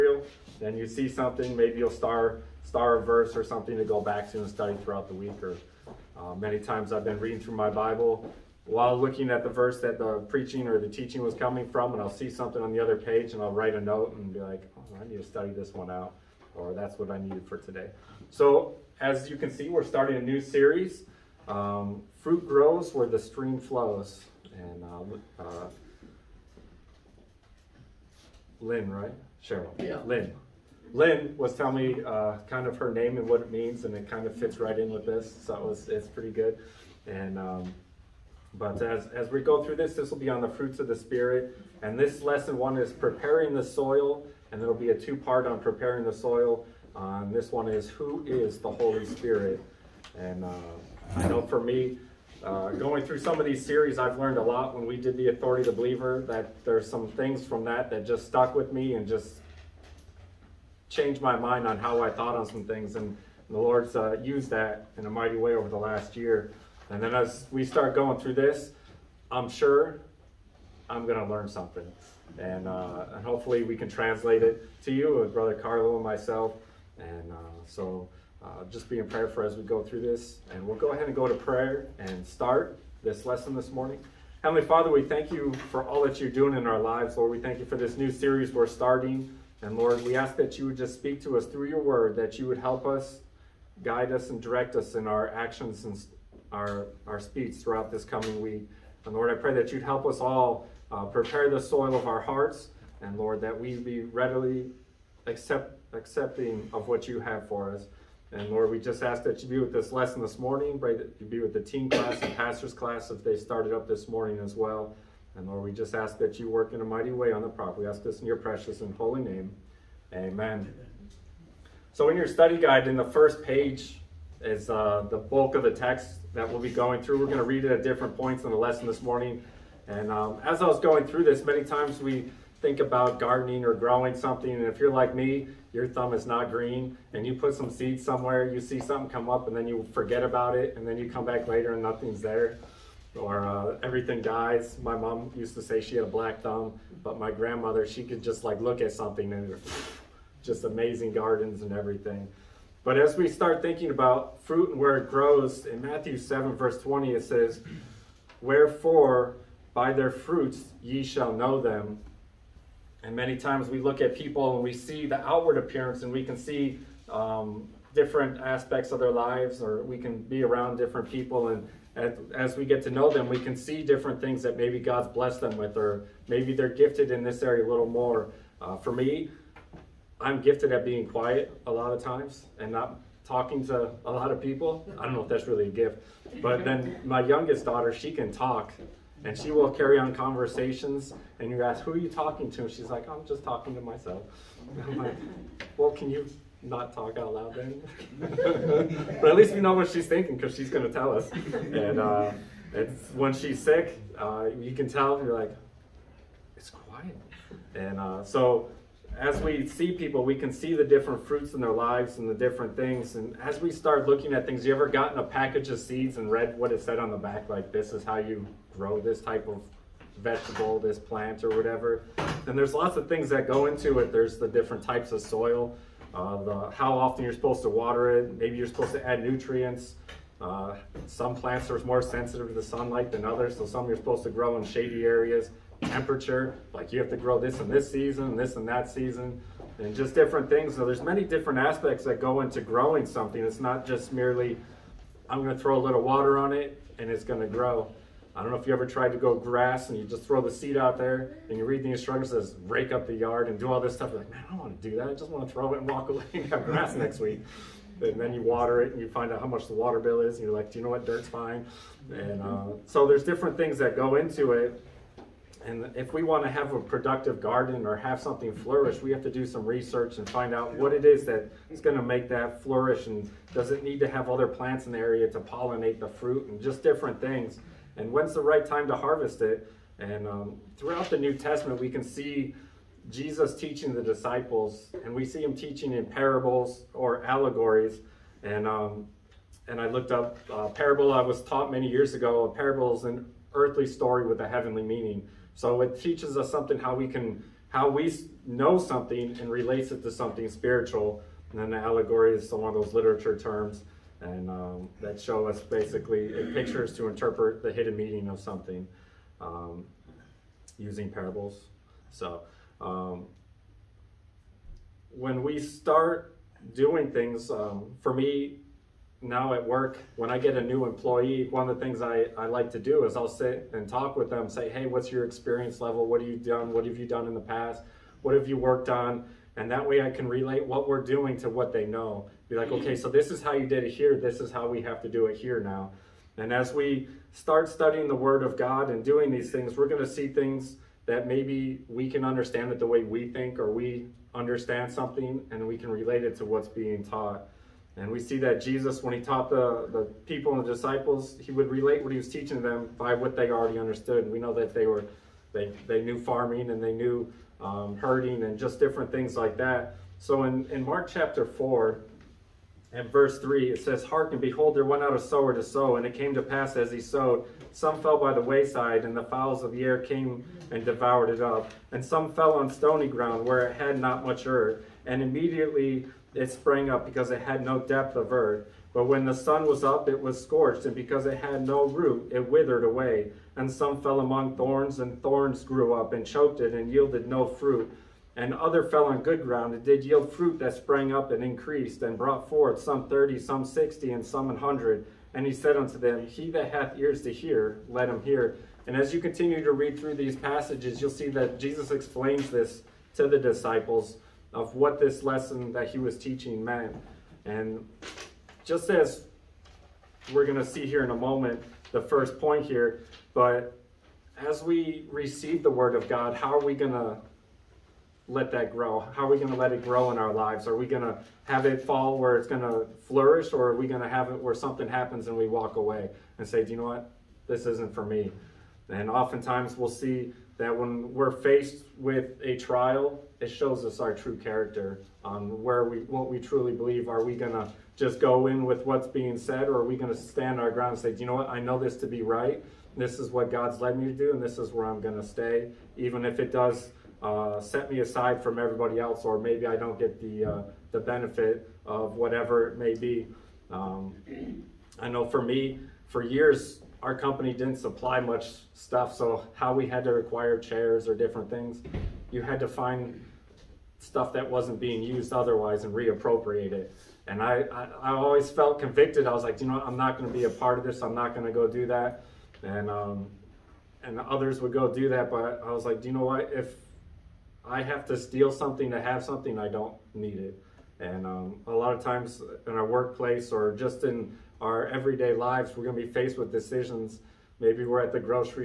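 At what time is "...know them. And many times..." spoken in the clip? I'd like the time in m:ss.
2:41.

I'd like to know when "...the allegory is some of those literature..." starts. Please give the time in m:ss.
5:01.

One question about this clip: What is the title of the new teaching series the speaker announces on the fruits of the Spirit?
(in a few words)
Fruit Grows Where the Stream Flows.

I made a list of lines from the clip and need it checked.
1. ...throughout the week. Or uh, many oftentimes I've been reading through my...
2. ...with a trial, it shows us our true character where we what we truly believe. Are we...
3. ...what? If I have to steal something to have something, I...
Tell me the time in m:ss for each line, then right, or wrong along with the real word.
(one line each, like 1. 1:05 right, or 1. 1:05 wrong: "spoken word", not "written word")
1. 0:04 wrong: "times", not "oftentimes"
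2. 7:11 right
3. 7:56 right.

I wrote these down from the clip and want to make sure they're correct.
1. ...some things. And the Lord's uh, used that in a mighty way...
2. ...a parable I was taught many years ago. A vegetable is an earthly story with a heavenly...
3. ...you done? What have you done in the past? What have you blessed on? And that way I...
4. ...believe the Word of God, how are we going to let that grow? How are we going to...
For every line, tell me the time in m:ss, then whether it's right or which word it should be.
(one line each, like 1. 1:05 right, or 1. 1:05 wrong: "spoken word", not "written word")
1. 1:02 right
2. 4:50 wrong: "parable", not "vegetable"
3. 5:26 wrong: "worked", not "blessed"
4. 6:55 wrong: "receive", not "believe".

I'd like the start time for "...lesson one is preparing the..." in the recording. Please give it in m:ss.
0:42.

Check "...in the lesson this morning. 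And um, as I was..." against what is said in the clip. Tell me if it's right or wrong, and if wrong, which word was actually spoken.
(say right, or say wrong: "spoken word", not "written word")
right.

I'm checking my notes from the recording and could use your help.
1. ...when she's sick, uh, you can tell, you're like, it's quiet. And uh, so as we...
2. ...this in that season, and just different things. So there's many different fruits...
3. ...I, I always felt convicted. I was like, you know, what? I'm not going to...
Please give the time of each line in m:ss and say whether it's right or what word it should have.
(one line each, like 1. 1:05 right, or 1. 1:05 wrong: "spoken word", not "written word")
1. 3:23 right
2. 3:58 wrong: "aspects", not "fruits"
3. 7:47 right.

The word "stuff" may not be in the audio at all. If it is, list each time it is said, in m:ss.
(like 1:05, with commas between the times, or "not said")
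4:13, 7:38, 7:43.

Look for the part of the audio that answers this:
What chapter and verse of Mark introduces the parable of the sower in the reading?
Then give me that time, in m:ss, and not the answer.
6:00.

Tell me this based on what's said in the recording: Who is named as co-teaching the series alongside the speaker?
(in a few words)
Brother Carlo.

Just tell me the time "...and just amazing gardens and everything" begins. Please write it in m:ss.
2:29.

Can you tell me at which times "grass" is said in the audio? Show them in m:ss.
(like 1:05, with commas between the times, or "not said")
4:09, 4:16.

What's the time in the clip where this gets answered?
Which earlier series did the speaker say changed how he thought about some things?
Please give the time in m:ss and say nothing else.
0:55.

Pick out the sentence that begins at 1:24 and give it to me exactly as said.
Heavenly Father, we thank you for all that you're doing in our lives, Lord.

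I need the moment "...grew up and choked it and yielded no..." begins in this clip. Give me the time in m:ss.
6:25.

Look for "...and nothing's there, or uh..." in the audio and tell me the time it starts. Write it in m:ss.
2:21.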